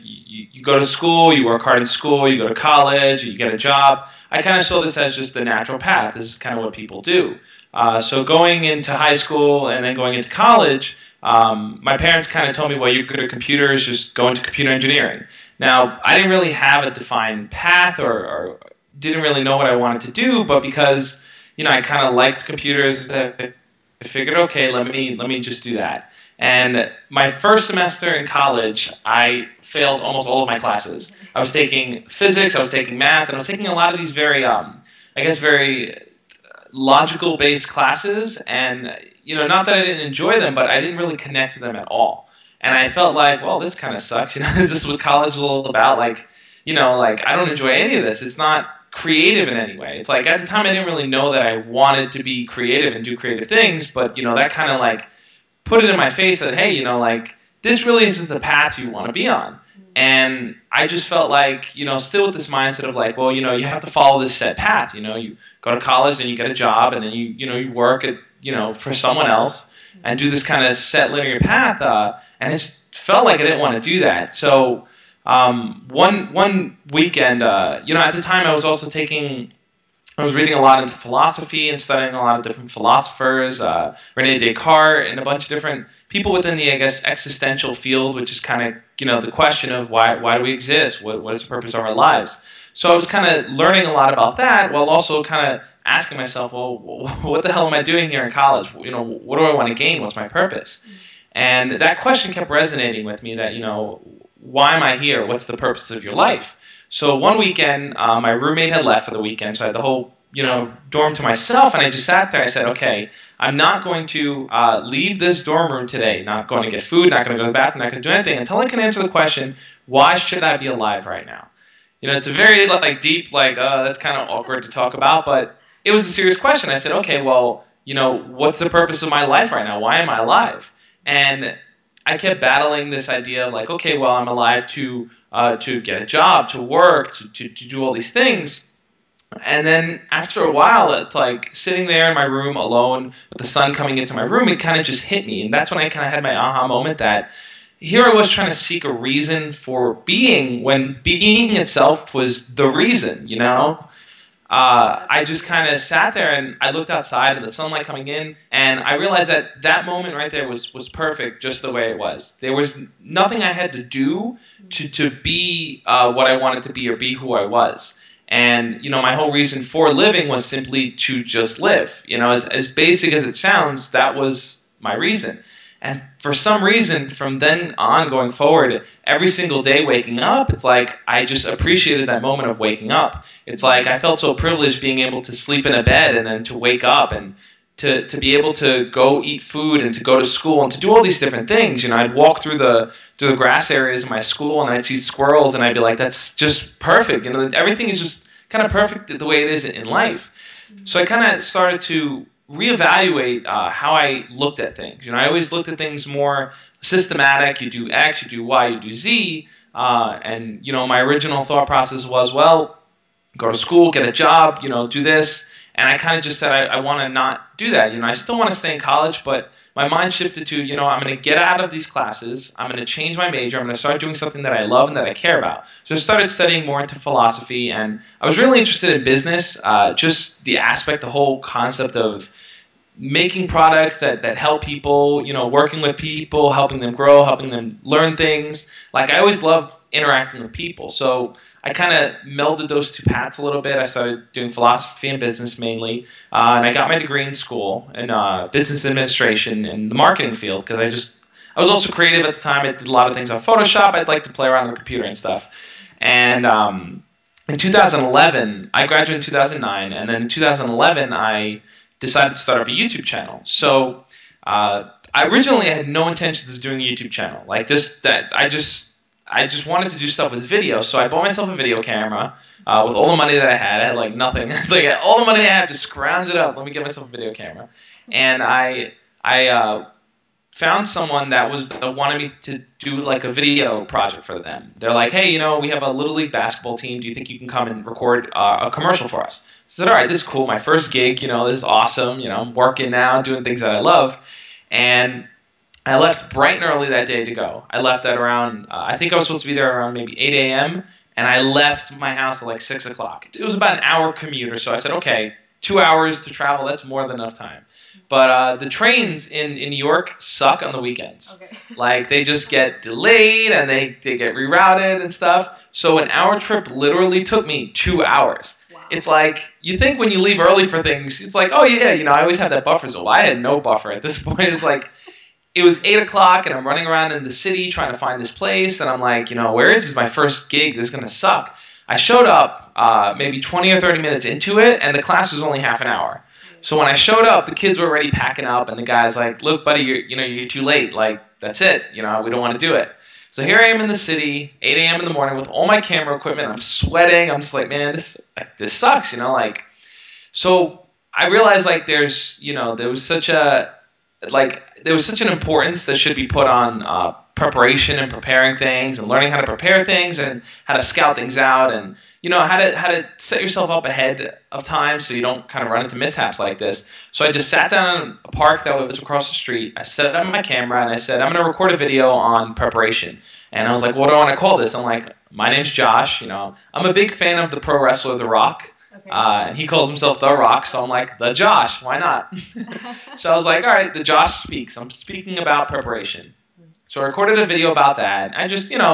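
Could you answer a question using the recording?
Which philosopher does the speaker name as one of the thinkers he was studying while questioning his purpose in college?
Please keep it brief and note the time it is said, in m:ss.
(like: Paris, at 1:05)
Rene Descartes, at 1:24.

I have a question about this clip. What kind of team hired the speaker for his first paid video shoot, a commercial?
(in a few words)
little league basketball.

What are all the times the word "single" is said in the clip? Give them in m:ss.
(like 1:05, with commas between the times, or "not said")
2:59.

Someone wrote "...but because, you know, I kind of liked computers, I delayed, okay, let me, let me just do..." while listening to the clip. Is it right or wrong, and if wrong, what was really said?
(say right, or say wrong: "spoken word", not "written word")
wrong: "figured", not "delayed".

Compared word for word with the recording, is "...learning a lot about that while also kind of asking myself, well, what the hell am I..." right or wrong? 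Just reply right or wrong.
right.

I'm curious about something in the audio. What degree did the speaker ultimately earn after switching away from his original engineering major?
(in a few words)
business administration.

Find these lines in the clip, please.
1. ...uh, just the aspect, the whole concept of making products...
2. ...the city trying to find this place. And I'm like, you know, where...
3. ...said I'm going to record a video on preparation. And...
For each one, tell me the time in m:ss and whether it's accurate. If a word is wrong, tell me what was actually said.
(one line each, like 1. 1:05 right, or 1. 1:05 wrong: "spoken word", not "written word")
1. 3:49 right
2. 5:27 right
3. 6:10 right.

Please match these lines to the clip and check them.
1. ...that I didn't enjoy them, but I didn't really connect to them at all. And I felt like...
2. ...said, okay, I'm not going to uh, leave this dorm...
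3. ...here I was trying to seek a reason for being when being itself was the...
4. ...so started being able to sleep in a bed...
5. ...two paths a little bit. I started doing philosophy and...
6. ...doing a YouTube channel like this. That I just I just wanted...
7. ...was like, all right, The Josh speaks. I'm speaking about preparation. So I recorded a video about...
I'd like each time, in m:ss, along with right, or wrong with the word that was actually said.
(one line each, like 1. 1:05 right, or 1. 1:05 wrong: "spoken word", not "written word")
1. 0:39 right
2. 1:52 right
3. 2:27 right
4. 3:04 wrong: "privileged", not "started"
5. 4:02 right
6. 4:26 right
7. 6:23 right.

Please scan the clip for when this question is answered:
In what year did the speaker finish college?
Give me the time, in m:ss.
4:19.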